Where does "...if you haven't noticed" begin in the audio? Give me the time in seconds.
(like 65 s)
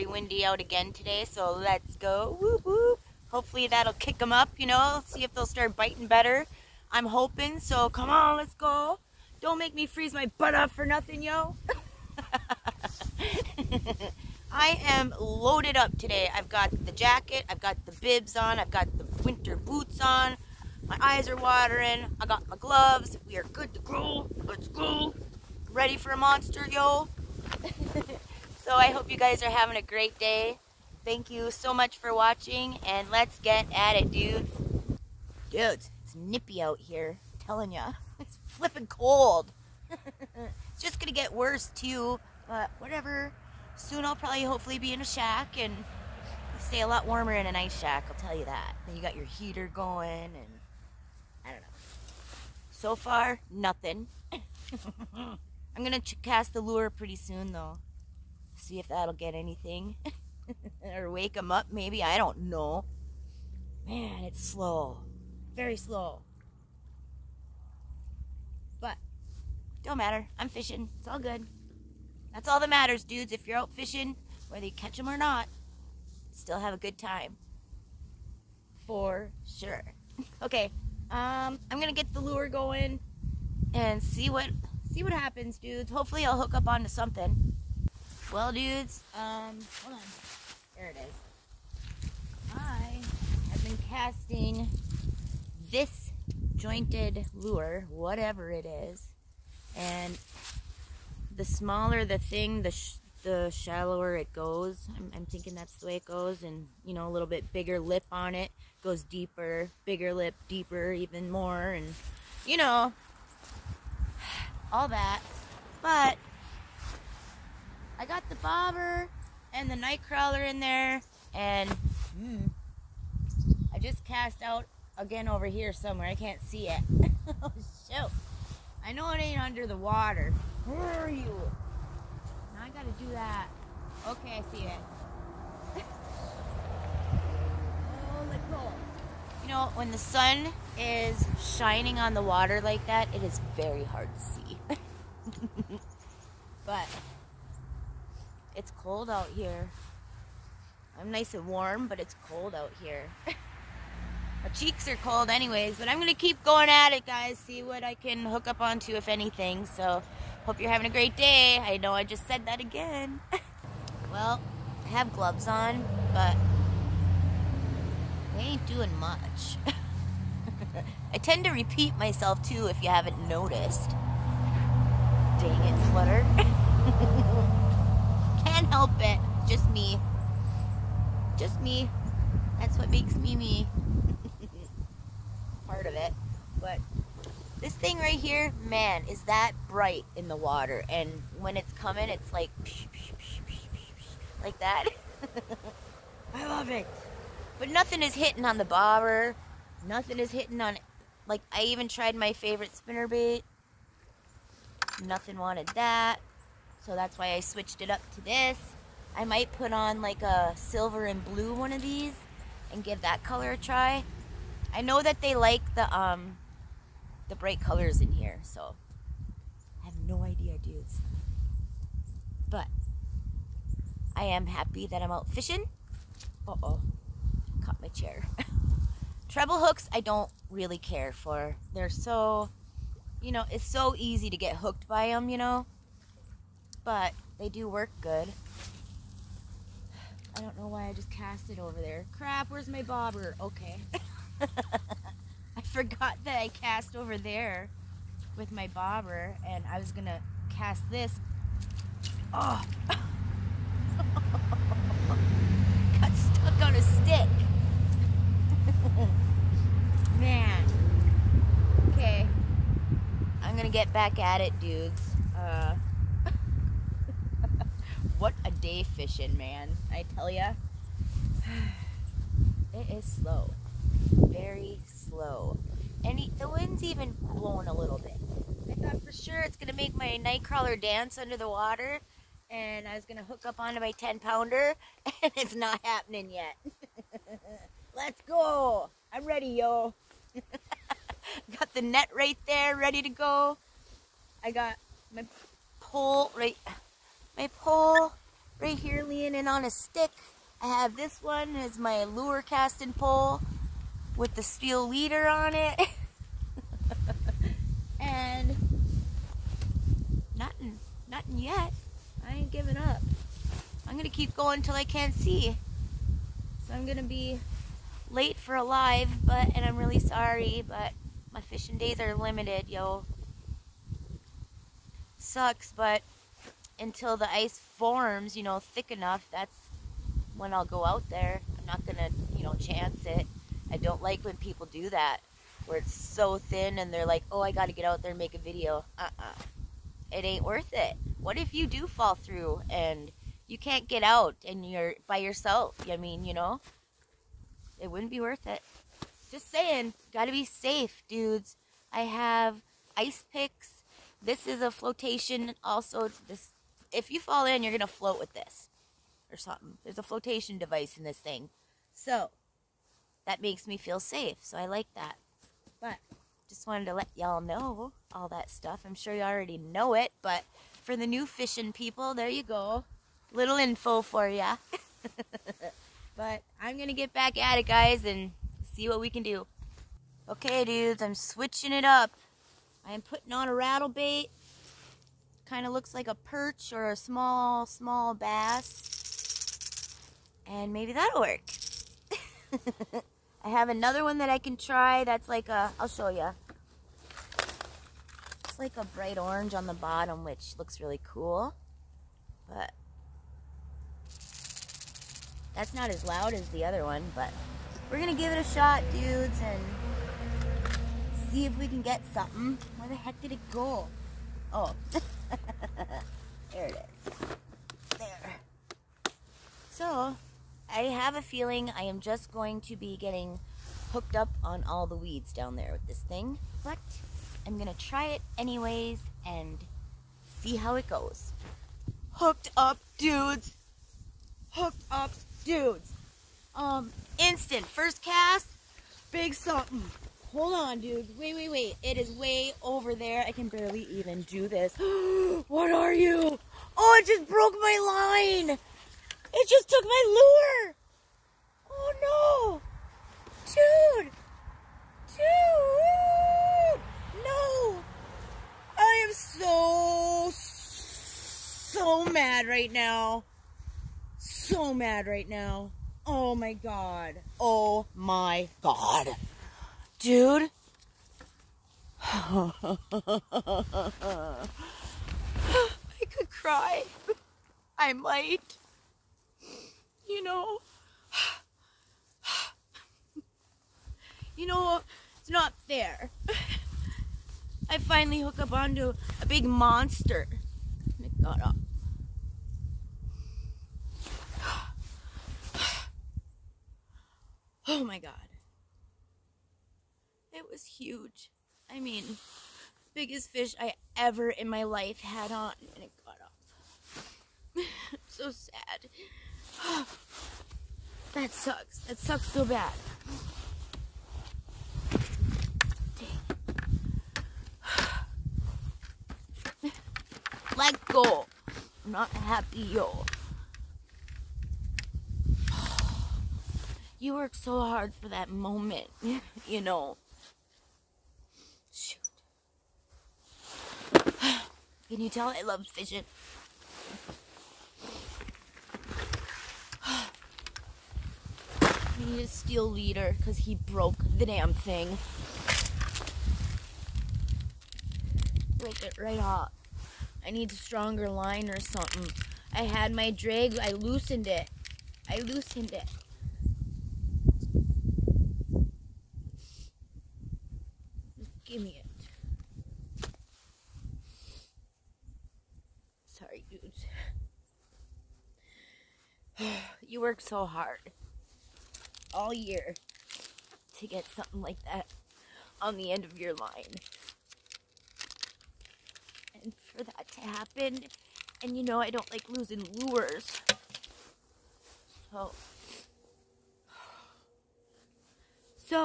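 172 s.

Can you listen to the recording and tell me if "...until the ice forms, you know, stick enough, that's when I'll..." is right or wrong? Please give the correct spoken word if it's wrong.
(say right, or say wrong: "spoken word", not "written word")
wrong: "thick", not "stick".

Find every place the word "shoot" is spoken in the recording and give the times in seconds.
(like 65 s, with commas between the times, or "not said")
127 s, 531 s.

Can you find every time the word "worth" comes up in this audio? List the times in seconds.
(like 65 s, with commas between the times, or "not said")
340 s, 348 s.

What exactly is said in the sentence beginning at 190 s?
And when it's coming, it's like, like that.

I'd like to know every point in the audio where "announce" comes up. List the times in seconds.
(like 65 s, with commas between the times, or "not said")
not said.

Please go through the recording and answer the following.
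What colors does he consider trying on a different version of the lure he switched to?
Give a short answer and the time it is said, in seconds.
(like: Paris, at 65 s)
silver and blue, at 210 s.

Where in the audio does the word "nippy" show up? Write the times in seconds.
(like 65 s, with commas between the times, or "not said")
36 s.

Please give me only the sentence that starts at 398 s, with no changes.
It's like a bright orange on the bottom, which looks really cool.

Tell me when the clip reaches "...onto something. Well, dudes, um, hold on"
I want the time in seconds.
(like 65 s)
86 s.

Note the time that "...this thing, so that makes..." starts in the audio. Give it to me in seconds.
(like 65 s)
361 s.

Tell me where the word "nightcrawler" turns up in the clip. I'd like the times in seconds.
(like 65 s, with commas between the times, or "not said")
119 s, 280 s.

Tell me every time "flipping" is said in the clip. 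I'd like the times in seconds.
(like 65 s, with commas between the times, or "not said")
38 s.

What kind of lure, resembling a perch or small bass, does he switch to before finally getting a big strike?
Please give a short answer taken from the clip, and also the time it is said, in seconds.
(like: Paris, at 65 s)
rattle bait, at 383 s.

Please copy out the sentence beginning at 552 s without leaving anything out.
I had my drag, I loosened it.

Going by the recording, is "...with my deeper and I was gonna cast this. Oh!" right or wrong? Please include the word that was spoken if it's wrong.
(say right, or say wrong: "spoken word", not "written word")
wrong: "bobber", not "deeper".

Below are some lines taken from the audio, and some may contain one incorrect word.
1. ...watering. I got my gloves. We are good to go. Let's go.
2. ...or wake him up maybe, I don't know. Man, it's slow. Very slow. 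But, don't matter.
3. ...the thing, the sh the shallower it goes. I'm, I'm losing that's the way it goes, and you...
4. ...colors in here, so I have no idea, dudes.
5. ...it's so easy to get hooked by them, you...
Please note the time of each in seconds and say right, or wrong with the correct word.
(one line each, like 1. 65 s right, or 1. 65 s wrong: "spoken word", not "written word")
1. 21 s right
2. 60 s right
3. 102 s wrong: "thinking", not "losing"
4. 217 s right
5. 233 s right.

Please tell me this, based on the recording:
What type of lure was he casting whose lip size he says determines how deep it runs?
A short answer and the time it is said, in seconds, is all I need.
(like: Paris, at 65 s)
jointed lure, at 96 s.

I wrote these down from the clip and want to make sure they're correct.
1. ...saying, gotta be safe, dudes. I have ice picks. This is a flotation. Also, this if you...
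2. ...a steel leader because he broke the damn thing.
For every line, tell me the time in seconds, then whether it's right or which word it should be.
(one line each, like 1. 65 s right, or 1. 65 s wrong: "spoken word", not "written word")
1. 349 s right
2. 542 s right.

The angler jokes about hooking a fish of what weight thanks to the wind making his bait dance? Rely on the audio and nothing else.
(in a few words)
10 pounds.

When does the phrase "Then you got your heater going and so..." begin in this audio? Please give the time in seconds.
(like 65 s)
48 s.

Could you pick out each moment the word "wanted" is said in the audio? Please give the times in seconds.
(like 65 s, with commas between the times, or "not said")
205 s, 366 s.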